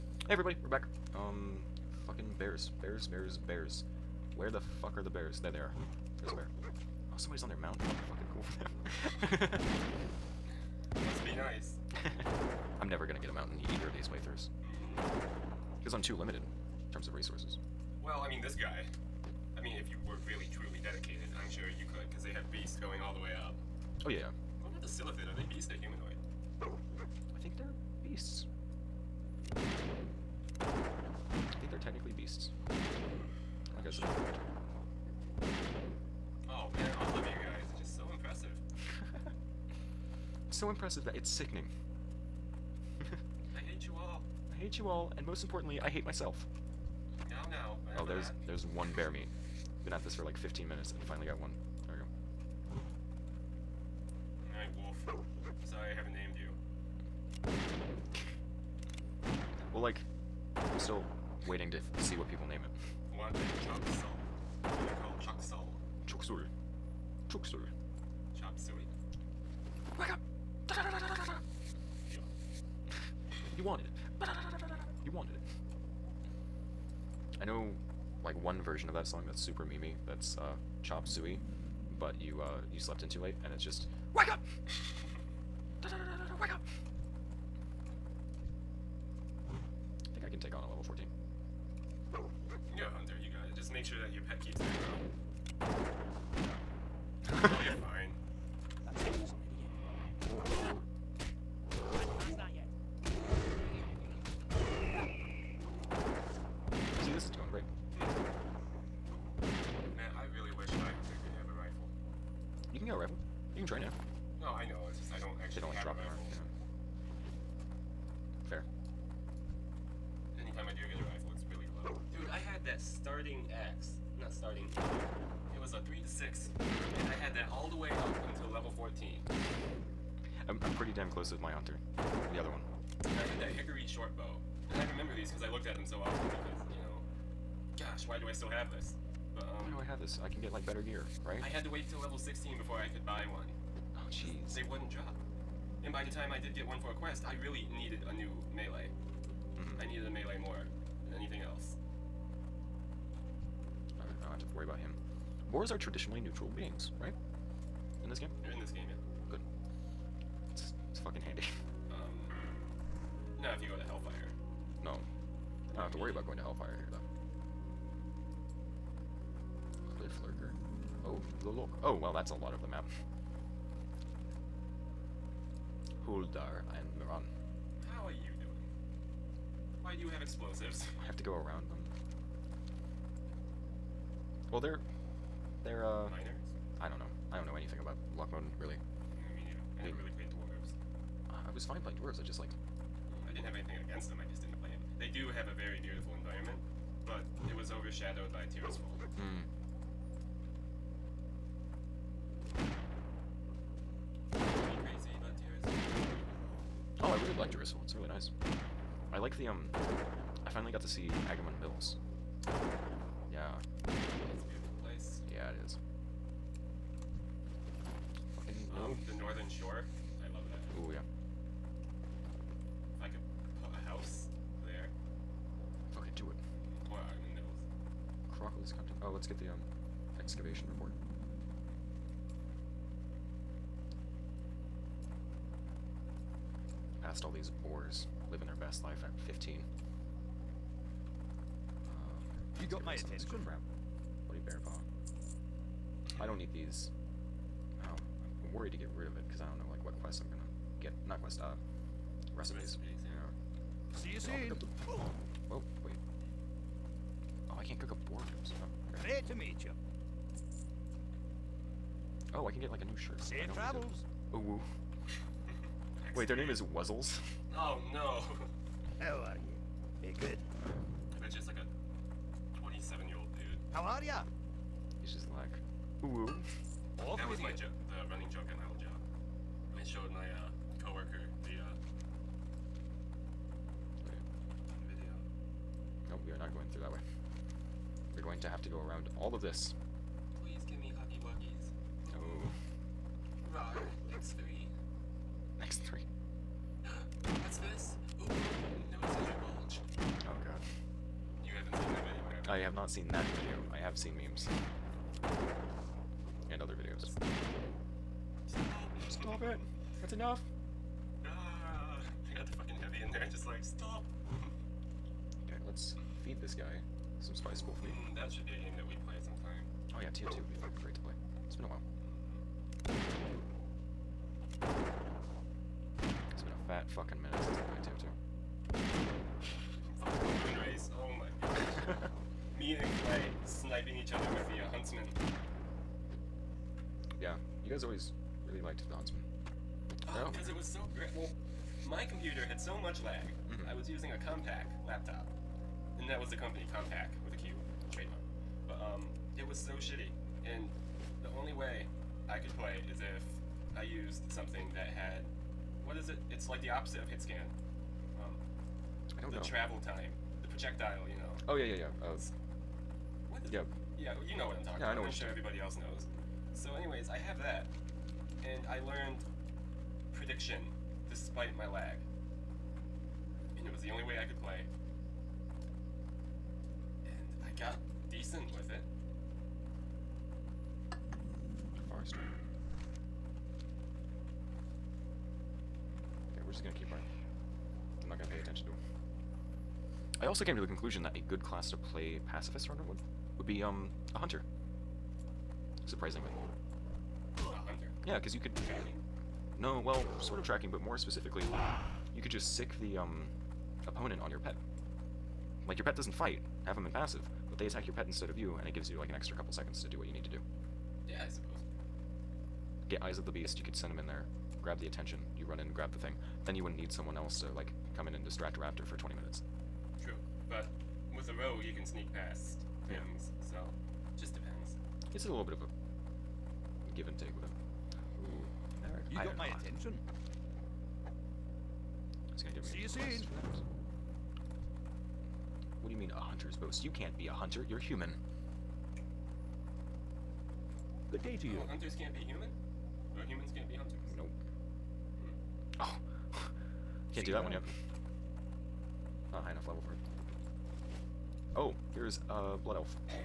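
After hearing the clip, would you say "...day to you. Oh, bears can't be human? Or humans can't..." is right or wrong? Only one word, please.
wrong.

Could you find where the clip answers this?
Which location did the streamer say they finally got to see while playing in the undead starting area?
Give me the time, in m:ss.
3:31.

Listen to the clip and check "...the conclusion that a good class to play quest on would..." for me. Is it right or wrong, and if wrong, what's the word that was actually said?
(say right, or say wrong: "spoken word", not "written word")
wrong: "pacifist", not "quest".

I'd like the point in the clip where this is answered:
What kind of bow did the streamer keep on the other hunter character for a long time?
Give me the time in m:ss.
2:13.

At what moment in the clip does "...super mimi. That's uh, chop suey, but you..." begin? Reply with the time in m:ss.
1:19.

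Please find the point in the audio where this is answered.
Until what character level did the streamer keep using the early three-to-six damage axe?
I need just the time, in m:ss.
2:08.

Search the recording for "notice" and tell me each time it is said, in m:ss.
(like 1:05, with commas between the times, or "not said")
4:58.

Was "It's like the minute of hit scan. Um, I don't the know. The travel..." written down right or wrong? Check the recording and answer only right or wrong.
wrong.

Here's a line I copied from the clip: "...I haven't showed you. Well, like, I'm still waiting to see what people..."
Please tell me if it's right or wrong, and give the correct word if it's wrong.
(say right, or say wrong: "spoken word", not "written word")
wrong: "named", not "showed".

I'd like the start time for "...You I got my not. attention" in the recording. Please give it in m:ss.
7:09.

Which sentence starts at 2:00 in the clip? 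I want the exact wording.
Anytime I do get a rifle, it's really low.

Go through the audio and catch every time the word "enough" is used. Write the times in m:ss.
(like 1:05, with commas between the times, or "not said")
5:10, 7:29.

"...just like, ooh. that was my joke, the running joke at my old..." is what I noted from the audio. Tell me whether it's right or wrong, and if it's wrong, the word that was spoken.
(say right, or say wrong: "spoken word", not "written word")
right.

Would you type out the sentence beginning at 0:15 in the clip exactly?
Because I'm too limited in terms of resources.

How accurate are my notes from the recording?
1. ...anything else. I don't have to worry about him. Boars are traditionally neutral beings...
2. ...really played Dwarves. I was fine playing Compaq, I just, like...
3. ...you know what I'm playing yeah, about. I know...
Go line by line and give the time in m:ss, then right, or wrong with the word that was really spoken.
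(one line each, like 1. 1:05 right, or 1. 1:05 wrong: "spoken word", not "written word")
1. 2:31 right
2. 3:10 wrong: "Dwarves", not "Compaq"
3. 6:04 wrong: "talking", not "playing".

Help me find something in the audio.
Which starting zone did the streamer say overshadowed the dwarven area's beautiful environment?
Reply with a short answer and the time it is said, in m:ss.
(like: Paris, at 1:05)
Tirisfal, at 3:18.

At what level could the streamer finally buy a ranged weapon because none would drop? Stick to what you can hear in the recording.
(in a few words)
16.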